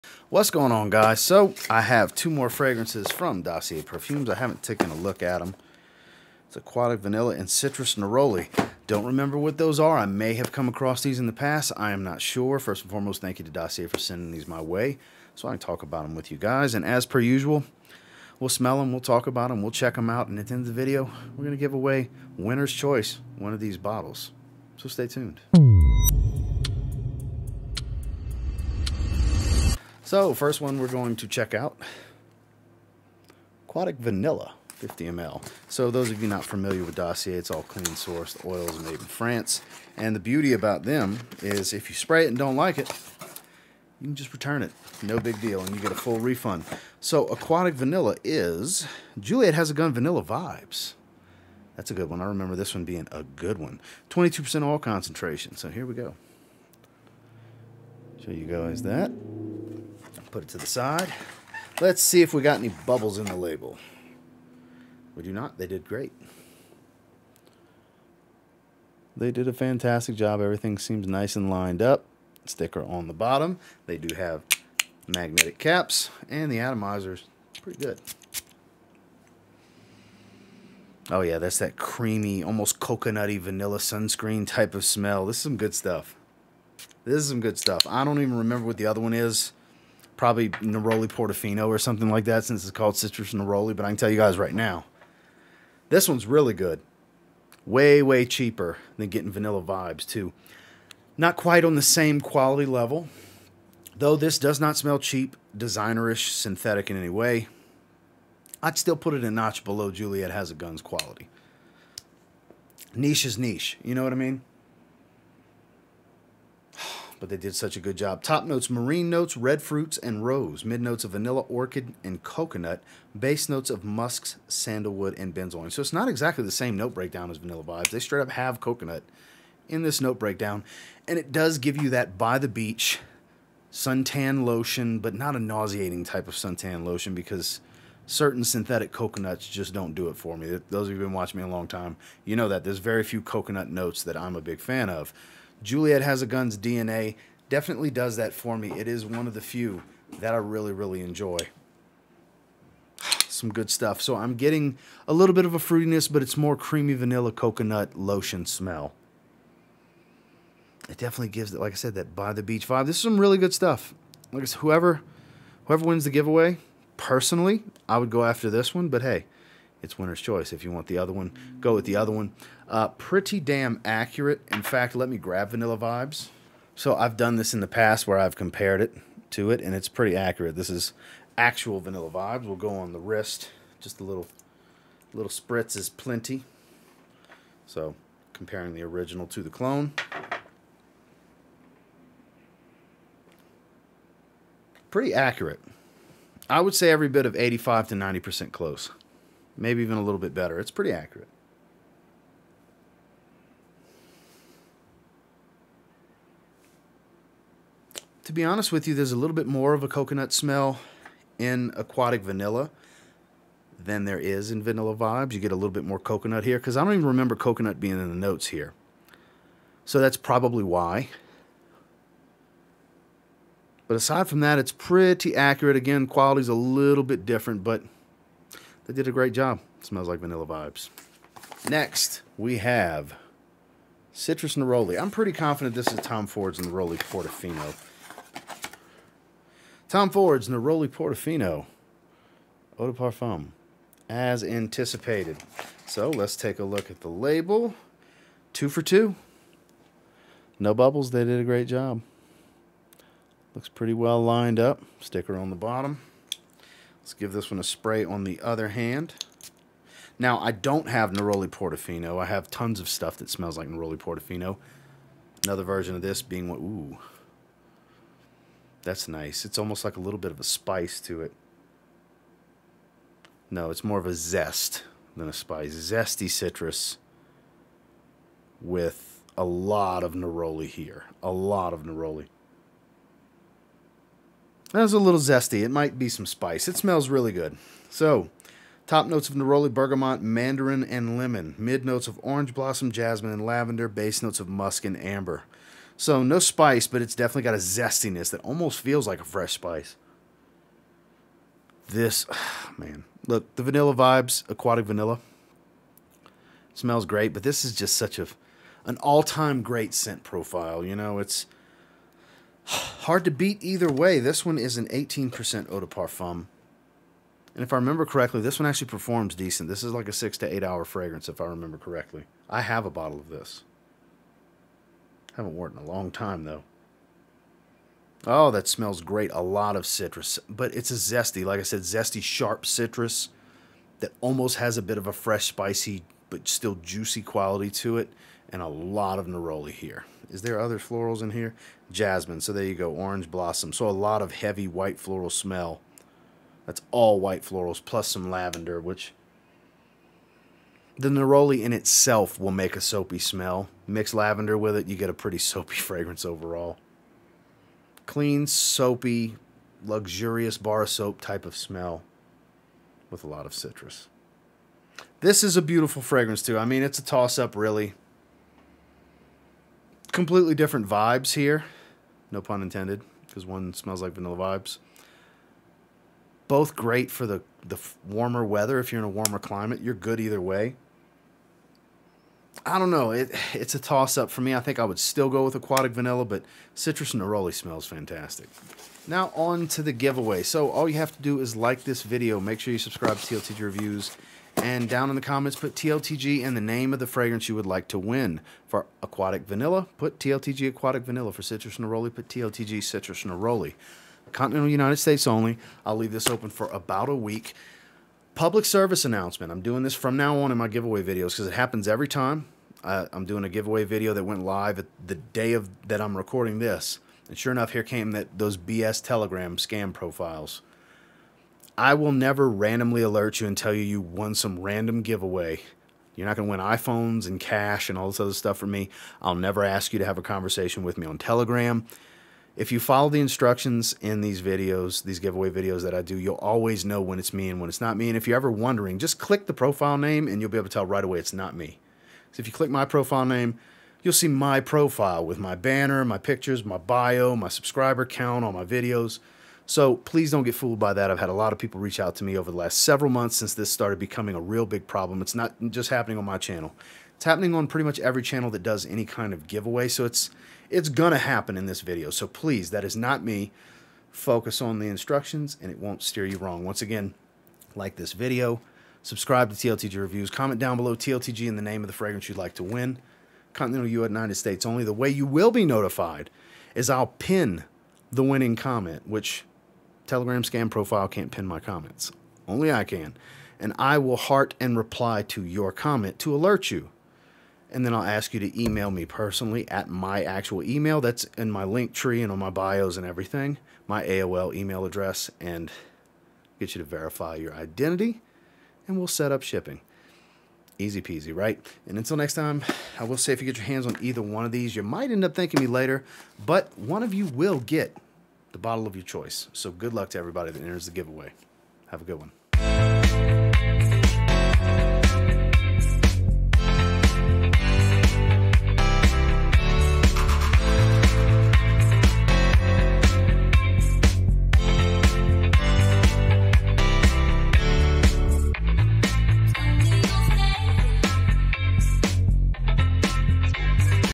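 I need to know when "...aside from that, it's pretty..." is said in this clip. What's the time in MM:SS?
03:43.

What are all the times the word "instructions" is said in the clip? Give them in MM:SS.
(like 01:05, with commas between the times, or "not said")
07:13, 07:44.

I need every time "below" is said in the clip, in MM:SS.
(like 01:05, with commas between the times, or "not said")
01:49, 07:50.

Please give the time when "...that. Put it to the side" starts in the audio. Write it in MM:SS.
00:58.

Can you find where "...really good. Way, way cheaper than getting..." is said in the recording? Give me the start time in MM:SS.
01:36.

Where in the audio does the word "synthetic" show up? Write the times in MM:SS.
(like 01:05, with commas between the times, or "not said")
01:46, 02:18.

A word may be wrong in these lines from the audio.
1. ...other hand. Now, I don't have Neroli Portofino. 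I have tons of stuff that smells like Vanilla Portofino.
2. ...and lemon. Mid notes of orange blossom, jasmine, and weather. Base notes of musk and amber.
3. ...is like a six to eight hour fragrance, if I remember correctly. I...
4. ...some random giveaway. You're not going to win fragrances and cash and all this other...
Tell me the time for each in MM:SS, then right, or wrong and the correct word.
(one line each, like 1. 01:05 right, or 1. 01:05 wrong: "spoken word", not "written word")
1. 04:18 wrong: "Neroli", not "Vanilla"
2. 04:50 wrong: "lavender", not "weather"
3. 05:19 right
4. 07:04 wrong: "iPhones", not "fragrances".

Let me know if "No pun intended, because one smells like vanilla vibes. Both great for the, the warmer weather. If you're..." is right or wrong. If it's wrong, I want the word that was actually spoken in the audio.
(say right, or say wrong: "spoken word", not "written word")
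right.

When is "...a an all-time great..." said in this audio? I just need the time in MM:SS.
05:08.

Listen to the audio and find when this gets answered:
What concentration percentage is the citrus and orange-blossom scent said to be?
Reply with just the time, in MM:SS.
05:14.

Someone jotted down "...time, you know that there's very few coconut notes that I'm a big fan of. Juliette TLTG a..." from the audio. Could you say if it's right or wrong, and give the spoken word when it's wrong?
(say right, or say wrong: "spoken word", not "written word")
wrong: "Has", not "TLTG".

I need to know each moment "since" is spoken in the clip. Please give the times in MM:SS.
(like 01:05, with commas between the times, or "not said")
01:32, 07:33.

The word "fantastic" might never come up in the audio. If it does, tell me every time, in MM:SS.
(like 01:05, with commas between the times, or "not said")
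01:09, 06:27.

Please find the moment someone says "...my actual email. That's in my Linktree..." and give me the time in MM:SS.
08:09.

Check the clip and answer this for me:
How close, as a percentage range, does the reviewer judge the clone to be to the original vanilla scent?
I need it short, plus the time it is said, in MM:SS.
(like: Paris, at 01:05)
85 to 90%, at 03:17.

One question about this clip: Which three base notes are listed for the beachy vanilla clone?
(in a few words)
Musks, sandalwood, and benzoin.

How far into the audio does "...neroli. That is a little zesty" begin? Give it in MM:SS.
04:41.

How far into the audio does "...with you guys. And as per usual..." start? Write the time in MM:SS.
00:16.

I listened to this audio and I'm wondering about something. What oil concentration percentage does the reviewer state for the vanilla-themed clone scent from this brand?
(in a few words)
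22%.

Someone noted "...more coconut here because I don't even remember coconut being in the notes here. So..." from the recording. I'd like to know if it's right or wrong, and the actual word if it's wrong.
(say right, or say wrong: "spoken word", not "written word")
right.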